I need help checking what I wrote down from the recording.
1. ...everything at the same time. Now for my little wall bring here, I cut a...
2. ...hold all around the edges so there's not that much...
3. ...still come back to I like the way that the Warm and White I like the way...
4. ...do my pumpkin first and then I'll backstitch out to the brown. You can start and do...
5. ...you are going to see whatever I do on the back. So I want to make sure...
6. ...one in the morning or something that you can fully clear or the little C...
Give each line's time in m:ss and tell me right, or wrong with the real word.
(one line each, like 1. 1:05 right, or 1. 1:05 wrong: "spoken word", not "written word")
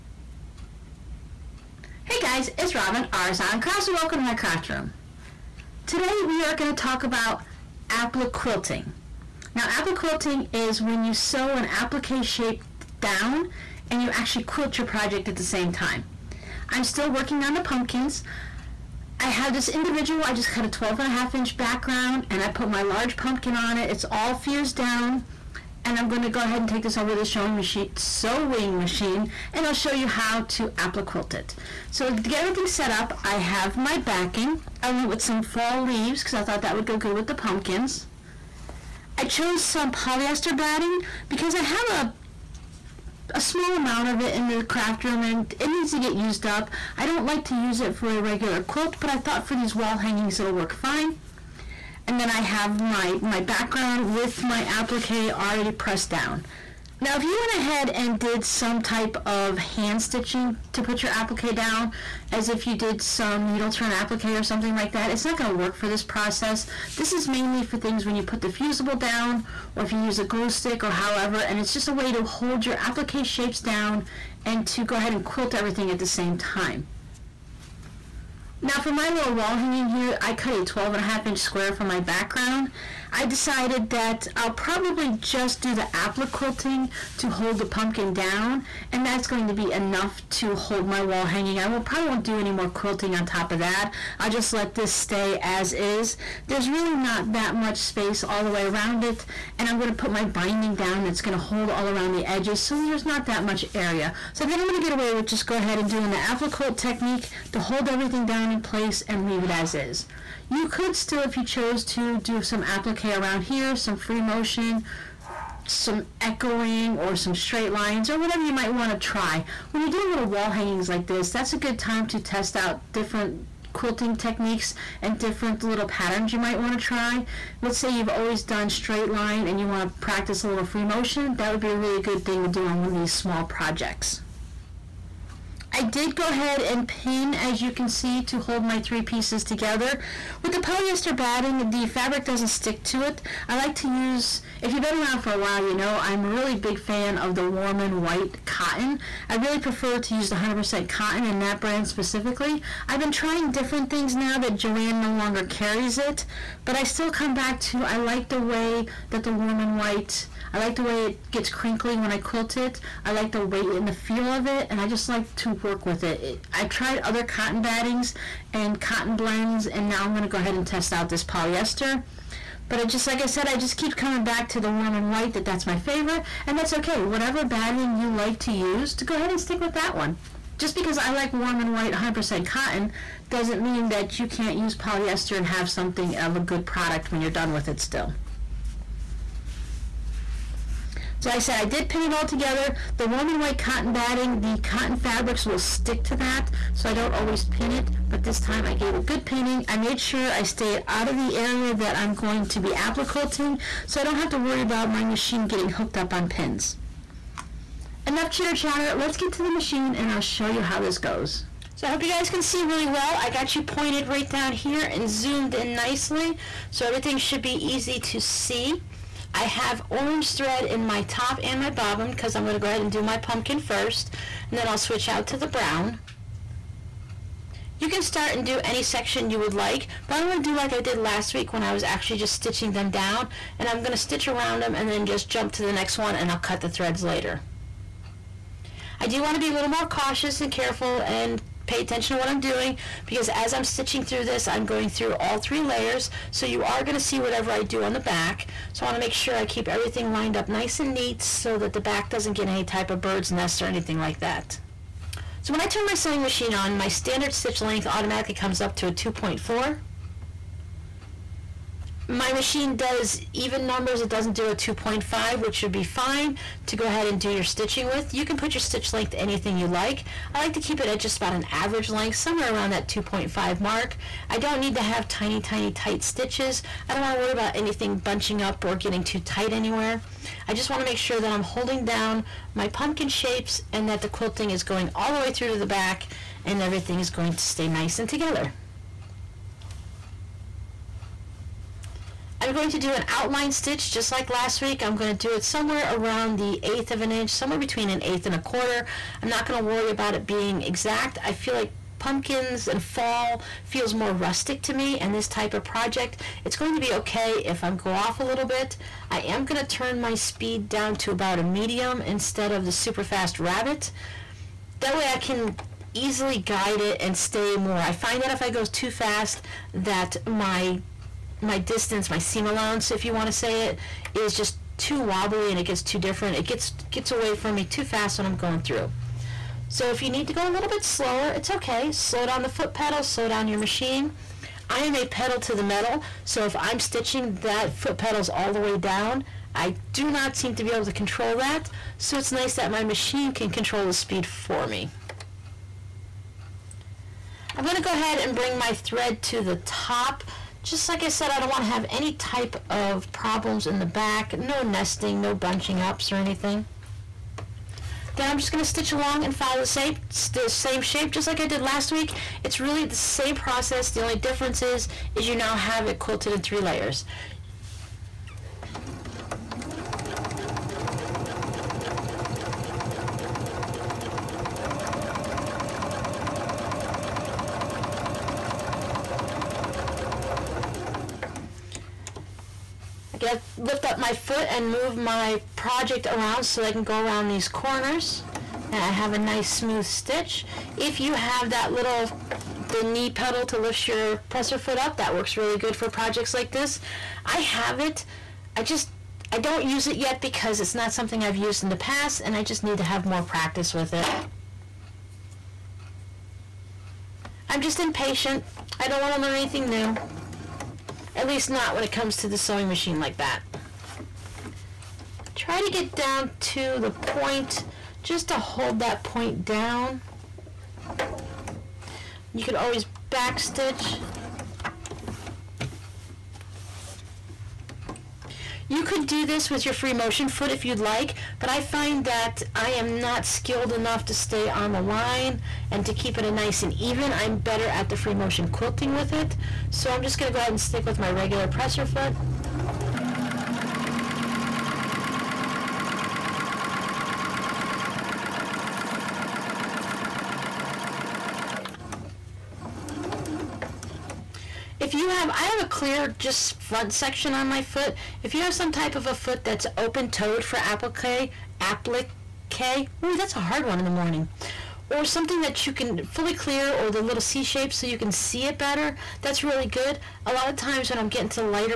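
1. 1:15 wrong: "hanging", not "bring"
2. 1:41 right
3. 2:36 right
4. 3:42 wrong: "switch", not "backstitch"
5. 4:06 right
6. 7:43 right.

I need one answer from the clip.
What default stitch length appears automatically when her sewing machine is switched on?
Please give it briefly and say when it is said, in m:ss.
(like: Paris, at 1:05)
2.4, at 4:18.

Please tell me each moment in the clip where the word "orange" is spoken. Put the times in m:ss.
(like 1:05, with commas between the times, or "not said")
3:39.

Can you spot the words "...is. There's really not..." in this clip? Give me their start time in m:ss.
1:35.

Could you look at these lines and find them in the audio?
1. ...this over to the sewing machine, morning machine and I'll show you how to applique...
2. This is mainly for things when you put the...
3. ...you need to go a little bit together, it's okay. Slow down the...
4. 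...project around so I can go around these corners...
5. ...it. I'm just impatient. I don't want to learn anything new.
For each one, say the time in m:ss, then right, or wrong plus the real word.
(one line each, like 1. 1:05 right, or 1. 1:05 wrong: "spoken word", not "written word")
1. 0:26 wrong: "sewing", not "morning"
2. 1:06 right
3. 5:30 wrong: "slower", not "together"
4. 6:25 right
5. 6:43 right.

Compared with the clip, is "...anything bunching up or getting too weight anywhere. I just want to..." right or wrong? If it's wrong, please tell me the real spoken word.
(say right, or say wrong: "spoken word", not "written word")
wrong: "tight", not "weight".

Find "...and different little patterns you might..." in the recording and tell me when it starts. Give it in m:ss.
2:05.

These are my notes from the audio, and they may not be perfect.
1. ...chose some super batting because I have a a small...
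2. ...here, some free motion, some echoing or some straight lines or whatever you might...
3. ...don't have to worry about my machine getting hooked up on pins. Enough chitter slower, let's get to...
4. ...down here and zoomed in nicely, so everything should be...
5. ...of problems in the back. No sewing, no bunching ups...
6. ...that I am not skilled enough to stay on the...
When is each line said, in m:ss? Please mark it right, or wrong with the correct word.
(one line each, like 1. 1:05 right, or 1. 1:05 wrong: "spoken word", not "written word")
1. 0:39 wrong: "polyester", not "super"
2. 1:53 right
3. 3:24 wrong: "chatter", not "slower"
4. 3:34 right
5. 5:52 wrong: "nesting", not "sewing"
6. 7:12 right.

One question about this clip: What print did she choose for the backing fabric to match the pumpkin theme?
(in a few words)
fall leaves.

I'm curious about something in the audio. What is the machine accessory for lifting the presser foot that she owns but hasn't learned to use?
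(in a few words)
knee pedal.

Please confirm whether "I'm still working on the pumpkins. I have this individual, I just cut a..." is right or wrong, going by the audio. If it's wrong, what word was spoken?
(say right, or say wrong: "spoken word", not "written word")
right.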